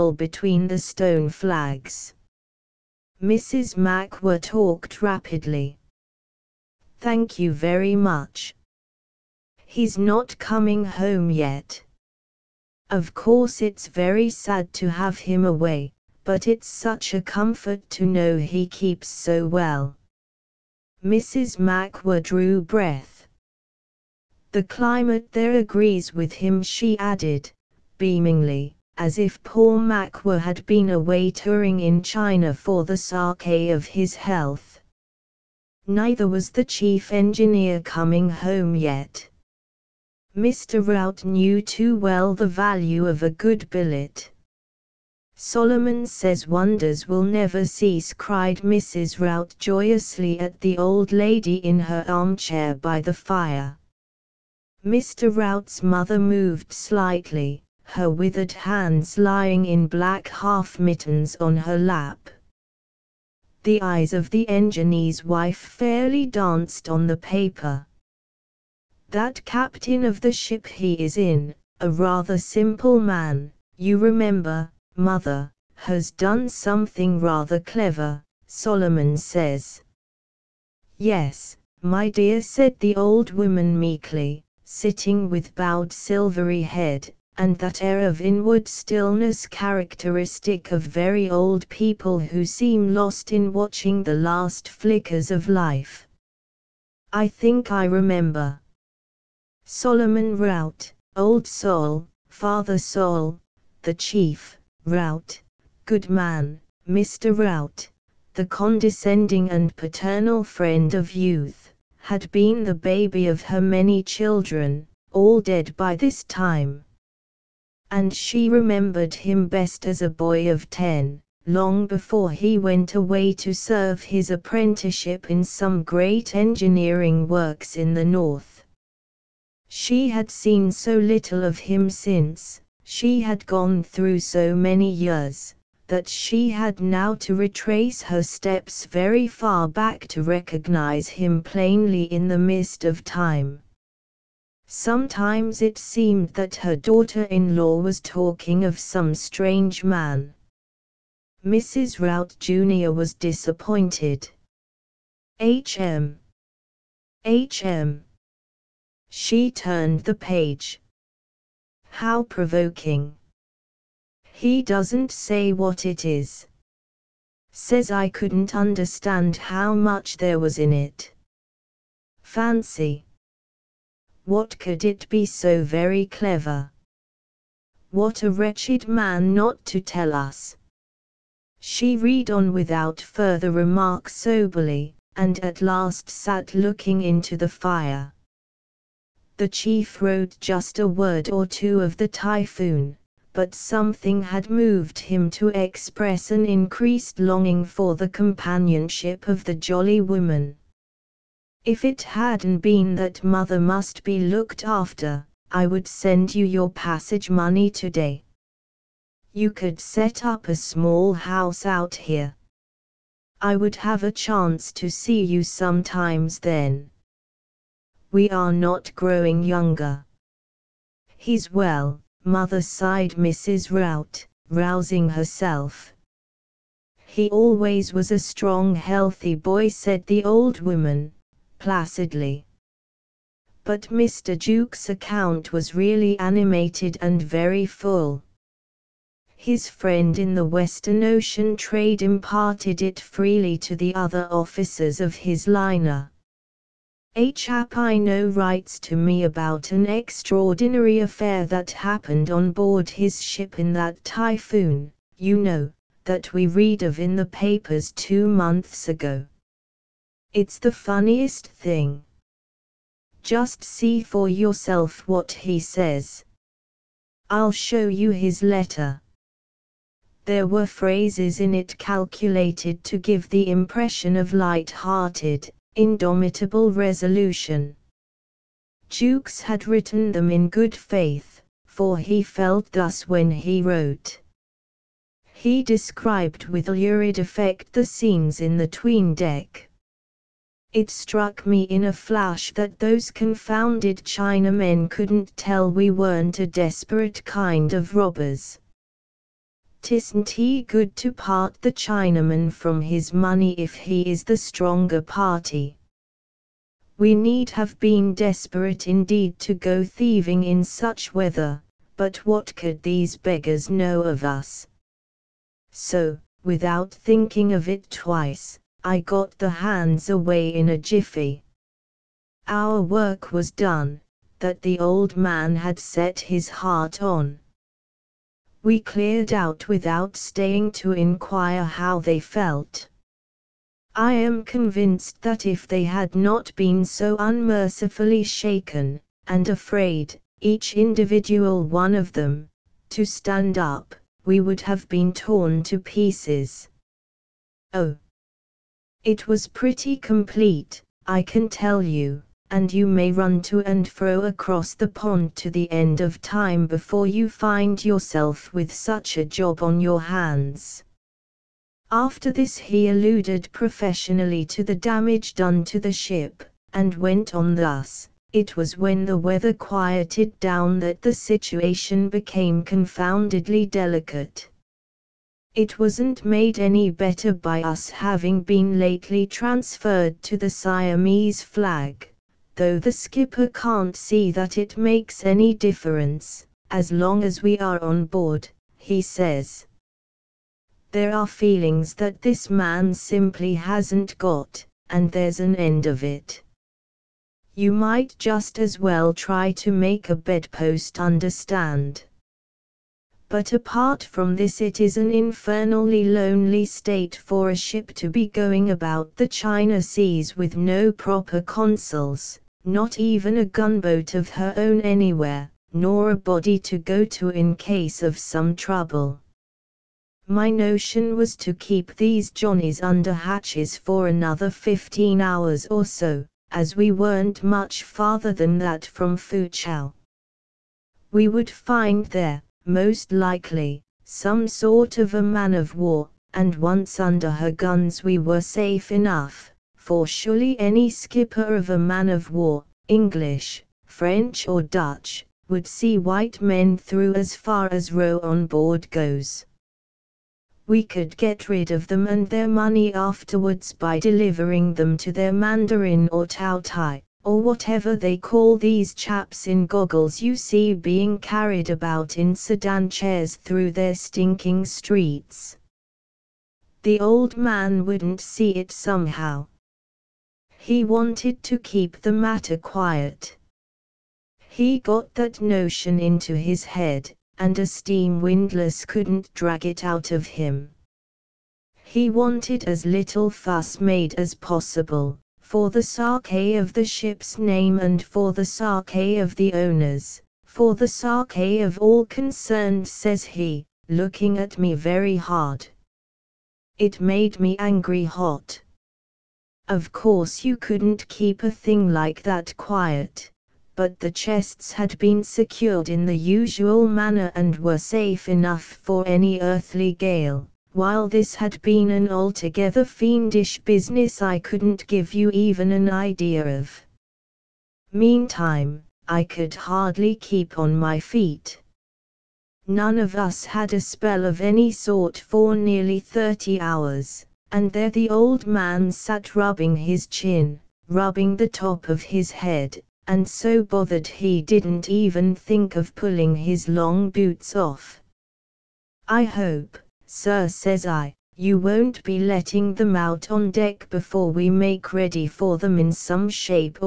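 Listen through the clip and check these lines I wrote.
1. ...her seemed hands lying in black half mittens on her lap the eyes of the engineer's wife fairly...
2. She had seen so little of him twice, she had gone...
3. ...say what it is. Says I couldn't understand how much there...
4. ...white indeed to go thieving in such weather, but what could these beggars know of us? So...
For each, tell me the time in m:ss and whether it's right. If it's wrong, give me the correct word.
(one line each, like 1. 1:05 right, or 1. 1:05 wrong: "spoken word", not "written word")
1. 0:57 wrong: "withered", not "seemed"
2. 2:09 wrong: "since", not "twice"
3. 2:45 right
4. 5:08 wrong: "desperate", not "white".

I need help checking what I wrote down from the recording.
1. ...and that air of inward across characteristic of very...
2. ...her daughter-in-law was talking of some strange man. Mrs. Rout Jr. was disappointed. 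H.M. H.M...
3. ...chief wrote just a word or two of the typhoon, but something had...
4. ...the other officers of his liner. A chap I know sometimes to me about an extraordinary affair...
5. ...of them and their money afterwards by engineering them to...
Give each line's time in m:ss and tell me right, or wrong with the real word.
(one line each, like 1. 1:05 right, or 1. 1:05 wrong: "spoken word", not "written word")
1. 1:27 wrong: "stillness", not "across"
2. 2:26 right
3. 3:09 right
4. 4:03 wrong: "writes", not "sometimes"
5. 7:31 wrong: "delivering", not "engineering".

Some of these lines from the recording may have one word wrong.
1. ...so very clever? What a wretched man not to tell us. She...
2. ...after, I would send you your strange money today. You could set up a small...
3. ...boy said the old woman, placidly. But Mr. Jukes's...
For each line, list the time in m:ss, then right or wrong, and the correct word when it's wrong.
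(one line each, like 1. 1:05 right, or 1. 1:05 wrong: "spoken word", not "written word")
1. 2:55 right
2. 3:24 wrong: "passage", not "strange"
3. 3:49 right.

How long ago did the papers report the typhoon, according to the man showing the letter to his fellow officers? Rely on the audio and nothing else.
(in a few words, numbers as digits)
Two months.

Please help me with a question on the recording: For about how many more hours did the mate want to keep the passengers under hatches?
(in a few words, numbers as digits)
15.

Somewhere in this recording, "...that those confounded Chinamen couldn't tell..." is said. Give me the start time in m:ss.
4:52.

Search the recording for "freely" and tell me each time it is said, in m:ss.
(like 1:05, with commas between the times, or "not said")
4:02.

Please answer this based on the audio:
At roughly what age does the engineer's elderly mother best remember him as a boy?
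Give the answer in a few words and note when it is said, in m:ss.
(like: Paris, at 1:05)
10, at 2:00.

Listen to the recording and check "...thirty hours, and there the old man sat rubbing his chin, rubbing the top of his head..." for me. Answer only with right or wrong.
right.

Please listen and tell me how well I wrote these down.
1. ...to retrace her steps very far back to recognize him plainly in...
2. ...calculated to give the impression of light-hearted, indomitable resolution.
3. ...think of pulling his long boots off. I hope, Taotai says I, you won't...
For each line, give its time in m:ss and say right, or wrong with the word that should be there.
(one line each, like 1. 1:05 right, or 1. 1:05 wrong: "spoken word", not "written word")
1. 2:17 right
2. 4:31 right
3. 8:55 wrong: "Sir", not "Taotai".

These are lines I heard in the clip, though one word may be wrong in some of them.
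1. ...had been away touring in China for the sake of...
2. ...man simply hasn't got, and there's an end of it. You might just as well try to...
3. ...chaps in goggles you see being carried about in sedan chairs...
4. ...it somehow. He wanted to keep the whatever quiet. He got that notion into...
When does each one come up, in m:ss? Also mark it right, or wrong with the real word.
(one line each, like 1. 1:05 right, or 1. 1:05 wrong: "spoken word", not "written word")
1. 0:30 right
2. 6:32 right
3. 7:38 right
4. 7:48 wrong: "matter", not "whatever".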